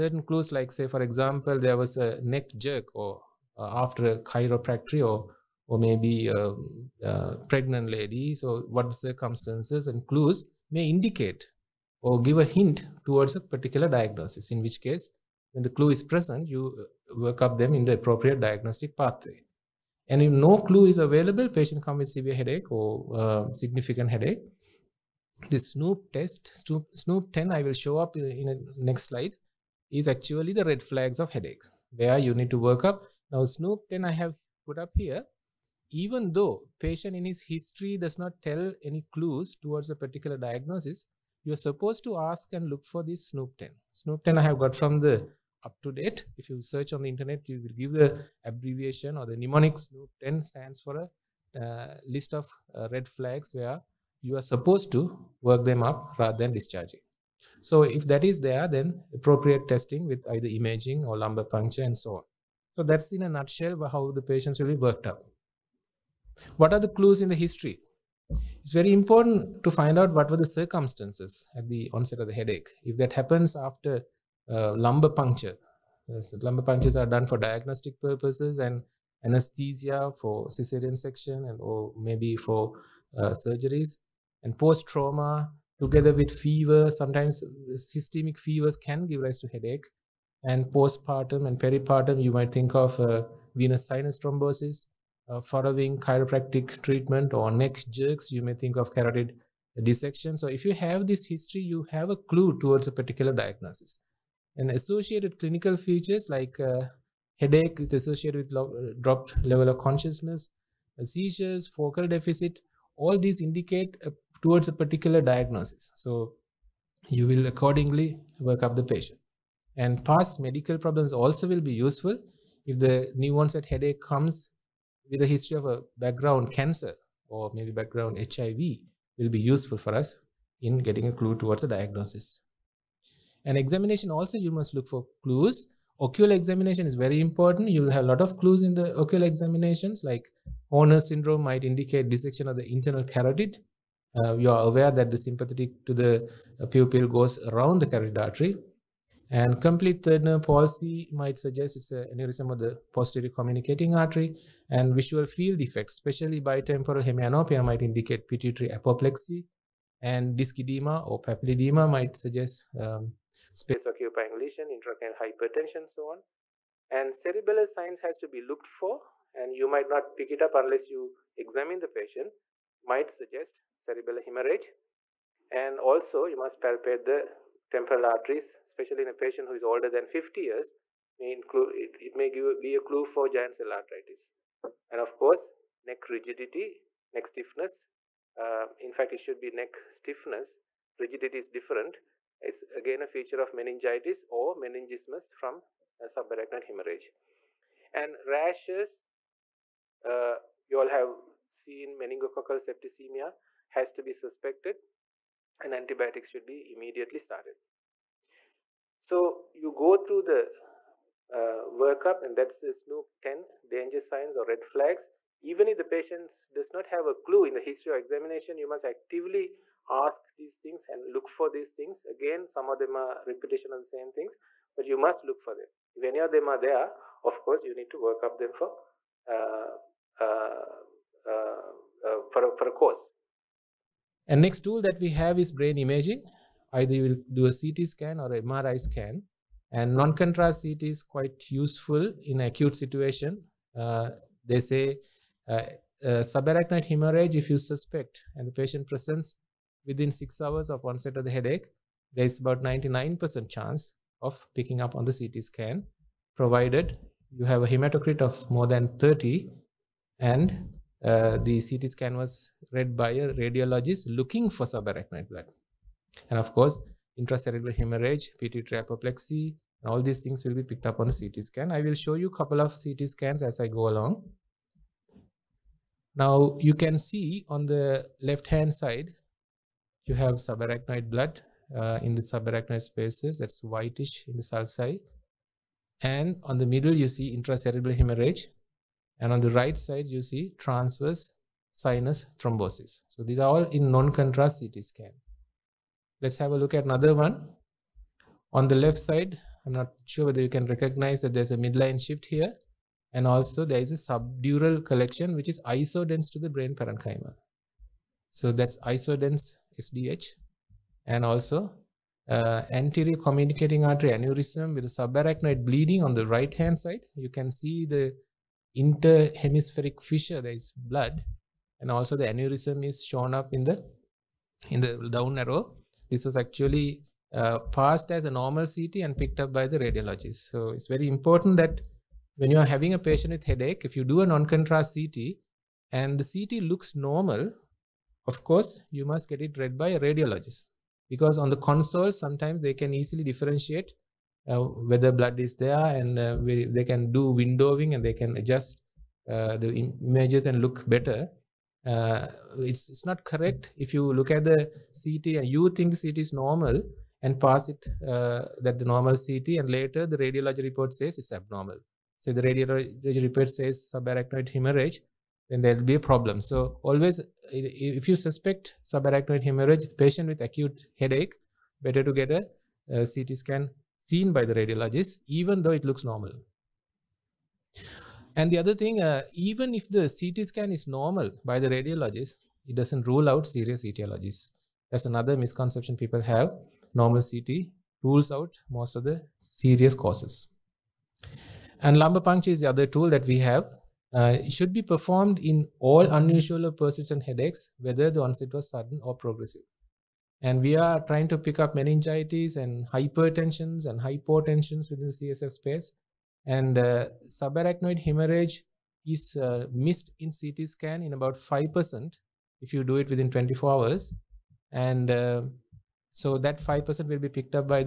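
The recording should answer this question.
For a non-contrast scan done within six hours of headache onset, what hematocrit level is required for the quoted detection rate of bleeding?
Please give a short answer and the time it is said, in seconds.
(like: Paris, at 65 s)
More than 30, at 258 s.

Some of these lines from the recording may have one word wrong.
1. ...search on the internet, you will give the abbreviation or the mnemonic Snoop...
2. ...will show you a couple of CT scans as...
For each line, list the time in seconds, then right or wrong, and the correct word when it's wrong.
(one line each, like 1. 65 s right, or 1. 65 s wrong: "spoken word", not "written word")
1. 46 s right
2. 271 s right.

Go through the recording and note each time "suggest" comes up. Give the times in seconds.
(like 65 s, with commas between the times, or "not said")
151 s, 162 s, 173 s.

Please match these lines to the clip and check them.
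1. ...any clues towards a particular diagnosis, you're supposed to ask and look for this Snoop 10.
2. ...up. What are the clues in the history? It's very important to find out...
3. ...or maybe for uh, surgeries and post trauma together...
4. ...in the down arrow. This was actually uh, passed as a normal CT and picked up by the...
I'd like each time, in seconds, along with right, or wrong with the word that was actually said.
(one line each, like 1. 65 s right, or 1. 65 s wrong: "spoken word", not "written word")
1. 38 s right
2. 65 s right
3. 81 s right
4. 324 s right.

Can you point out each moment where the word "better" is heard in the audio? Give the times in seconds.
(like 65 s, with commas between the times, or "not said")
350 s, 371 s.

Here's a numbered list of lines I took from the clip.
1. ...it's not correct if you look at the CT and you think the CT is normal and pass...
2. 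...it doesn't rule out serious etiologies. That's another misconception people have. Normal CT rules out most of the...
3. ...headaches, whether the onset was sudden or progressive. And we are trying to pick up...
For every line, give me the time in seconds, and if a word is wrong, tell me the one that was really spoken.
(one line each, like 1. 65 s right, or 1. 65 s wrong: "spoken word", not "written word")
1. 352 s right
2. 382 s right
3. 397 s right.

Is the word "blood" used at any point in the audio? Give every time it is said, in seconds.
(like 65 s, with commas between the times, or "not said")
265 s, 281 s, 320 s, 345 s.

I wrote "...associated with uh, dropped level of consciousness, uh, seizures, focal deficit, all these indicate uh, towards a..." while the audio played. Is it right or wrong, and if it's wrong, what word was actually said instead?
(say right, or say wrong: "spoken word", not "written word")
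right.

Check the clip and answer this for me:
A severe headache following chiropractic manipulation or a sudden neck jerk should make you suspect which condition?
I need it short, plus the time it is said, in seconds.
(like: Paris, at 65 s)
Carotid dissection, at 98 s.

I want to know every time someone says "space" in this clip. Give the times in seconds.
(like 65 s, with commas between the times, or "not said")
163 s, 282 s, 405 s.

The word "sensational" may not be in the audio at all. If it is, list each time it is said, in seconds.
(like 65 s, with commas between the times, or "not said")
not said.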